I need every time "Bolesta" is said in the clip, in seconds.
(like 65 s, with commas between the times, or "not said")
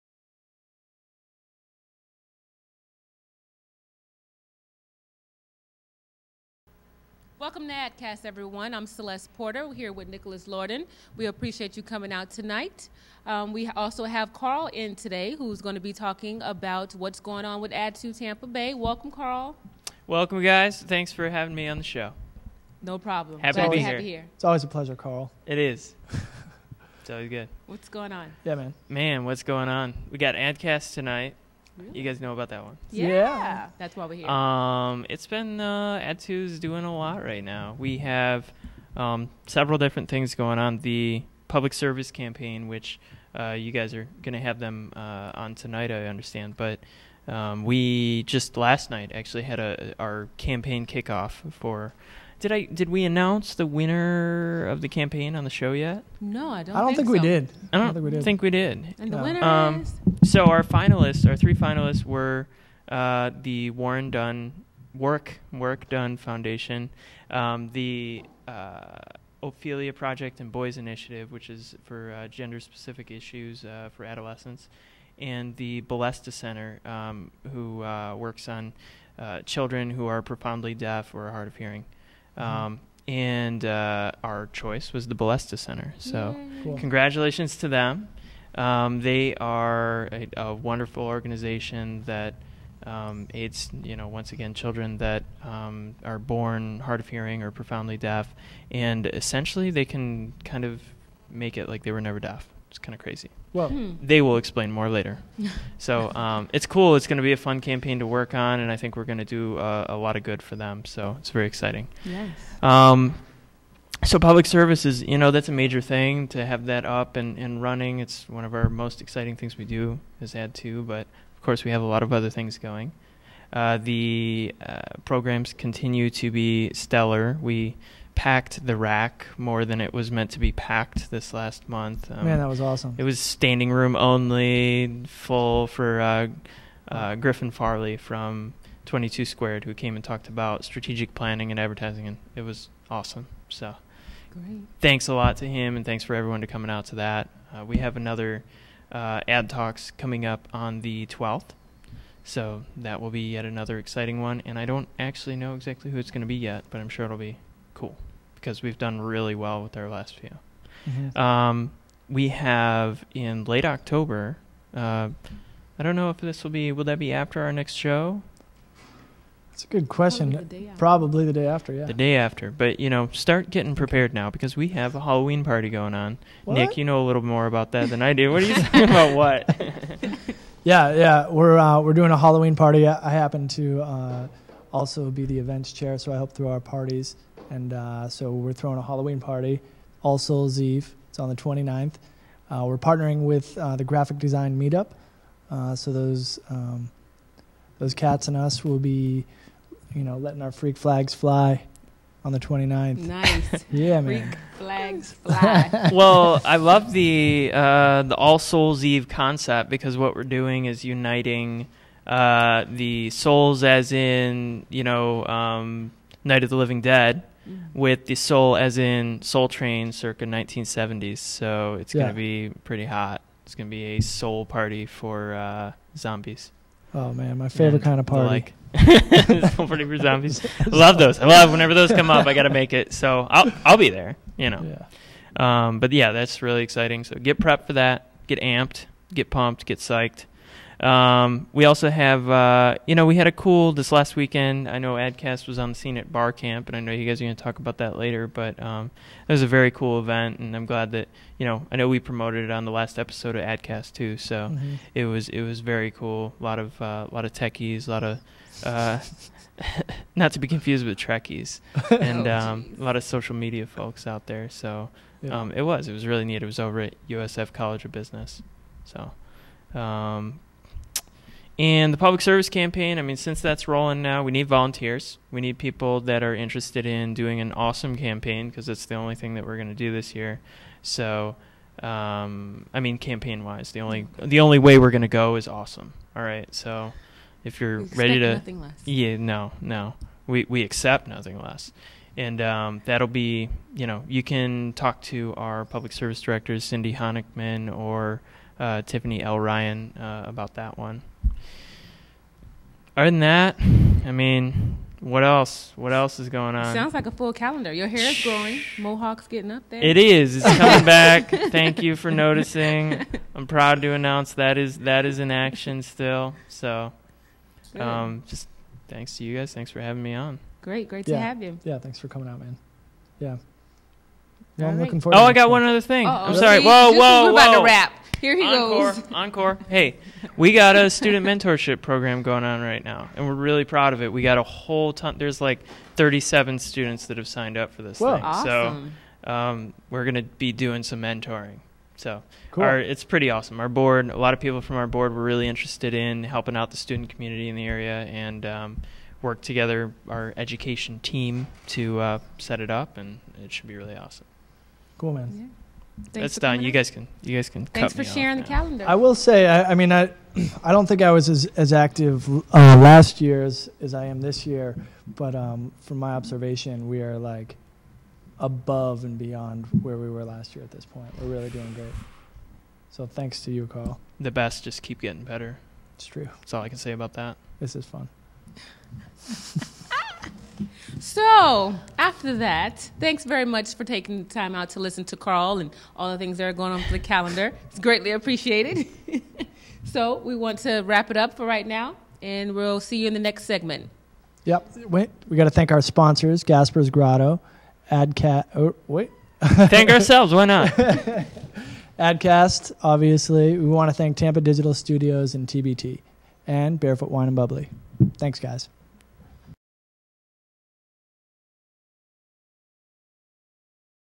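75 s, 85 s.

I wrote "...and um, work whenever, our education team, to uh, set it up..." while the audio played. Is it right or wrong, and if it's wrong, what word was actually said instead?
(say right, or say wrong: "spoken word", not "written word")
wrong: "together", not "whenever".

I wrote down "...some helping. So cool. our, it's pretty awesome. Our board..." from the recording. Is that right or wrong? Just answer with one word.
wrong.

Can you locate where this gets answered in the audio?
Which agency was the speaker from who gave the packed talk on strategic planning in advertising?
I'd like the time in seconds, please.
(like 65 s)
138 s.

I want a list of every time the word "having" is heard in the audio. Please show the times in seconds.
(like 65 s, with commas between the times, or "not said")
21 s, 319 s.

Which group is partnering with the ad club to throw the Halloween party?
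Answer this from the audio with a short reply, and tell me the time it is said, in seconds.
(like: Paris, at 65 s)
Graphic Design Meetup, at 193 s.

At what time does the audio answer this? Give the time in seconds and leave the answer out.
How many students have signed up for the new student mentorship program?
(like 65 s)
335 s.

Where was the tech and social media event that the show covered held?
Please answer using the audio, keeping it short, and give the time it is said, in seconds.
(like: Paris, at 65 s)
USF College of Business, at 267 s.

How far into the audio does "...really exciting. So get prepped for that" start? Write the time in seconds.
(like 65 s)
236 s.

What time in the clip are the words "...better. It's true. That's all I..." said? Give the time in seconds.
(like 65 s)
375 s.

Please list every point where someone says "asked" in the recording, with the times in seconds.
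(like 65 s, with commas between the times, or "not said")
not said.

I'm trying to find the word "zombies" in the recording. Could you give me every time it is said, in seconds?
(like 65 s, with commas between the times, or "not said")
225 s, 229 s.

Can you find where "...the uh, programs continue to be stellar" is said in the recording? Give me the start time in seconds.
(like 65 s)
123 s.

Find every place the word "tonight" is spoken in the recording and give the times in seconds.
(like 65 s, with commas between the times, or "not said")
12 s, 30 s, 45 s.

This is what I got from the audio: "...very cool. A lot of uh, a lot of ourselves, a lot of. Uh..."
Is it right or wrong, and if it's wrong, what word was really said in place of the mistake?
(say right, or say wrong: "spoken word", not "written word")
wrong: "techies", not "ourselves".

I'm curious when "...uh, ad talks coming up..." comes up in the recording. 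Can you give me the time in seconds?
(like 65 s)
148 s.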